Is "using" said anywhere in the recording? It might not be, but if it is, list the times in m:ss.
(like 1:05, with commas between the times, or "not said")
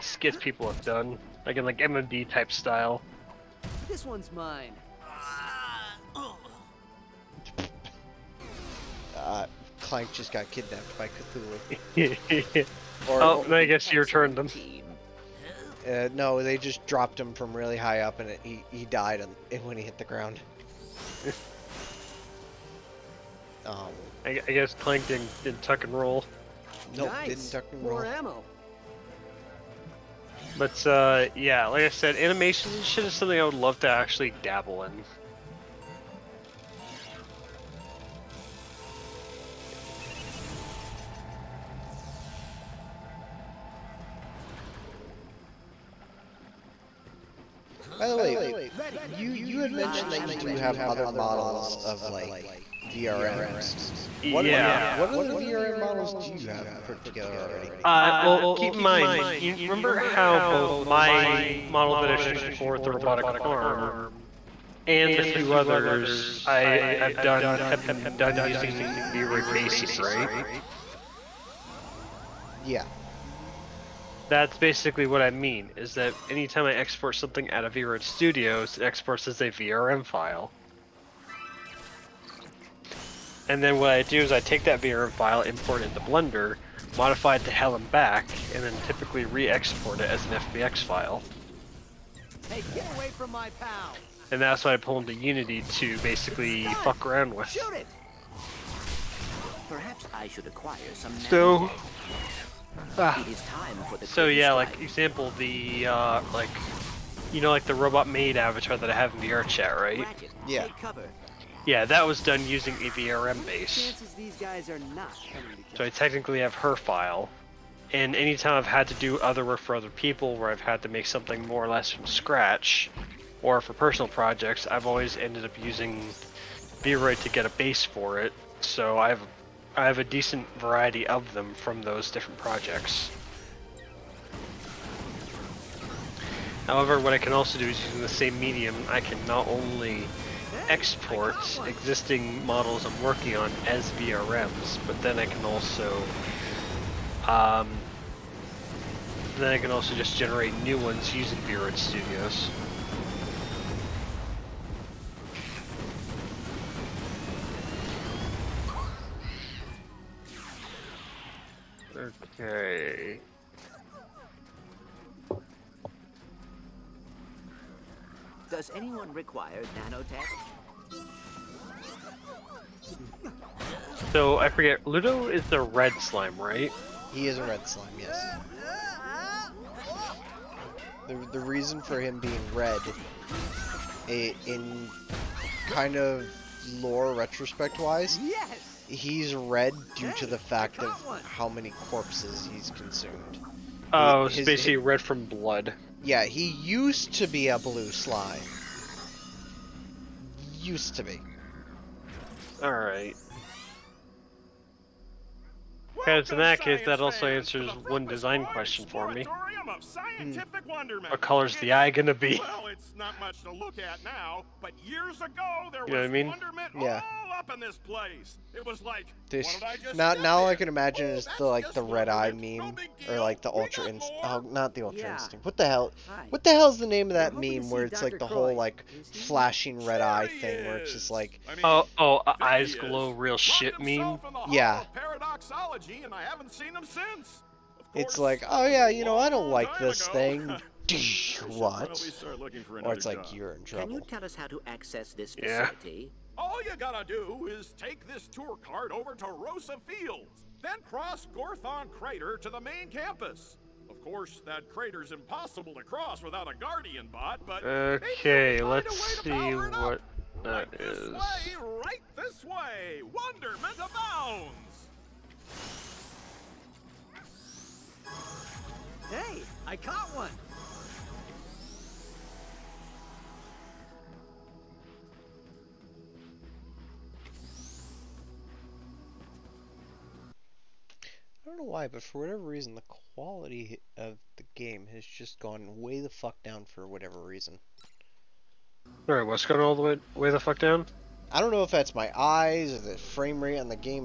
1:08, 1:52, 2:05, 2:17, 2:31.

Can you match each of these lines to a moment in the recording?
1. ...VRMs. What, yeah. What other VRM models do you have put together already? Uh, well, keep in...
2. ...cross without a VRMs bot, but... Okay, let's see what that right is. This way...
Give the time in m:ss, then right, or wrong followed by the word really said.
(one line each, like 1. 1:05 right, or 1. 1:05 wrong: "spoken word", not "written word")
1. 0:52 right
2. 4:15 wrong: "Guardian", not "VRMs".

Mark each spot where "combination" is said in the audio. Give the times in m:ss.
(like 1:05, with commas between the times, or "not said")
not said.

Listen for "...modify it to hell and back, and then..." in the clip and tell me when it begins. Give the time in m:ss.
1:26.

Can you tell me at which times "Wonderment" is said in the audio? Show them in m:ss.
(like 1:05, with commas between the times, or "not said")
4:23.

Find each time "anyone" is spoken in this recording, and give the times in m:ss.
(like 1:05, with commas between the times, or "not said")
2:48.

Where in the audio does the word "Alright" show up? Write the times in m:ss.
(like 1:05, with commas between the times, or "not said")
3:22, 4:49.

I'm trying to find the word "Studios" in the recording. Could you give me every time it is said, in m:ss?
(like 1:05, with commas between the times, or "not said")
1:18, 2:31.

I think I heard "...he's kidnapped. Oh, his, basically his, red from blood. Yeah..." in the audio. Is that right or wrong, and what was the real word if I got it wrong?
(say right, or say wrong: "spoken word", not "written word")
wrong: "consumed", not "kidnapped".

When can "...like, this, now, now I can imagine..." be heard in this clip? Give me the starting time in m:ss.
3:38.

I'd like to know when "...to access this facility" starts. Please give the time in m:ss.
4:04.